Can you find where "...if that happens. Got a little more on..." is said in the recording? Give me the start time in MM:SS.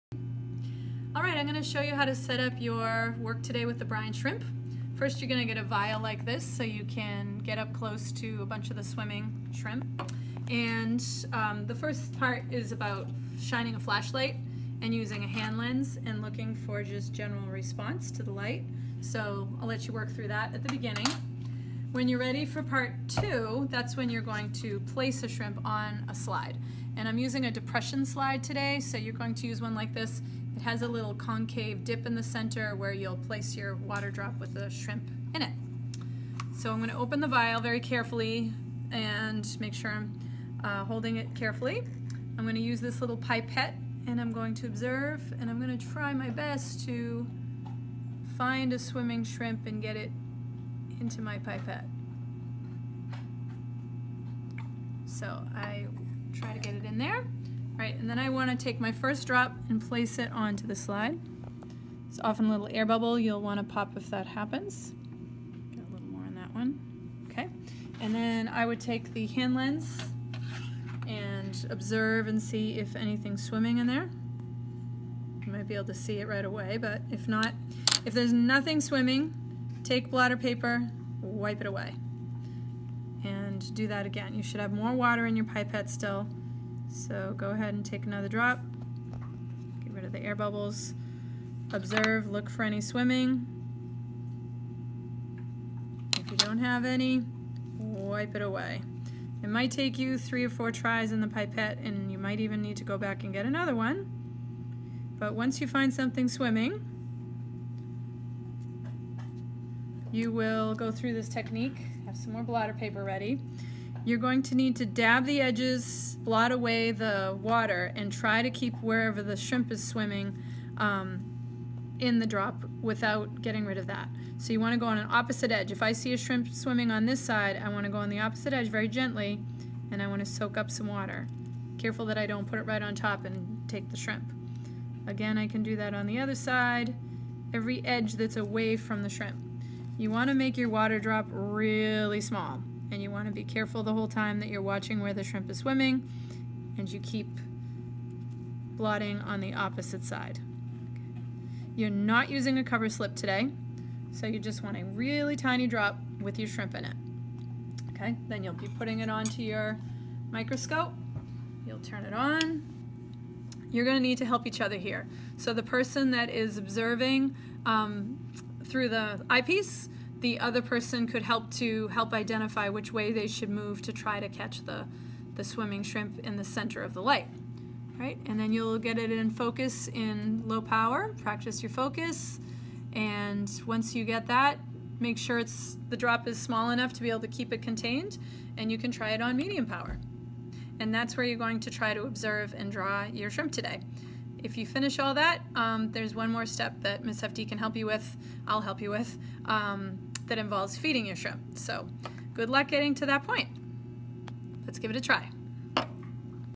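01:03.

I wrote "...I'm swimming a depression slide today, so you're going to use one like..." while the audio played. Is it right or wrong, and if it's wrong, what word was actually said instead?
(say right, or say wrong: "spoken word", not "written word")
wrong: "using", not "swimming".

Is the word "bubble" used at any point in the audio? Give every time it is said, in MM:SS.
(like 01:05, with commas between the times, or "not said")
01:02, 01:30.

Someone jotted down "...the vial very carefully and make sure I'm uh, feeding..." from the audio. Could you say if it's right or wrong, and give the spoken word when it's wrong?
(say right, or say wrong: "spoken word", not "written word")
wrong: "holding", not "feeding".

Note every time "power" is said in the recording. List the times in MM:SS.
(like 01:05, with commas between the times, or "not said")
03:00, 03:09.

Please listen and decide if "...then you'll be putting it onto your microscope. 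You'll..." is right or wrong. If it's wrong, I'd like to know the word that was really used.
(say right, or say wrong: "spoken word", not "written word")
right.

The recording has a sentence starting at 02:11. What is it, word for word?
Careful that I don't put it right on top and take the shrimp.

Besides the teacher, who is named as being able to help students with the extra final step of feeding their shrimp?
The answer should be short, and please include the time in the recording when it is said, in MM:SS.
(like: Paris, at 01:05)
Miss Hefty, at 03:17.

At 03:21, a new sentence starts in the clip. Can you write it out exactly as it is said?
So good luck getting to that point.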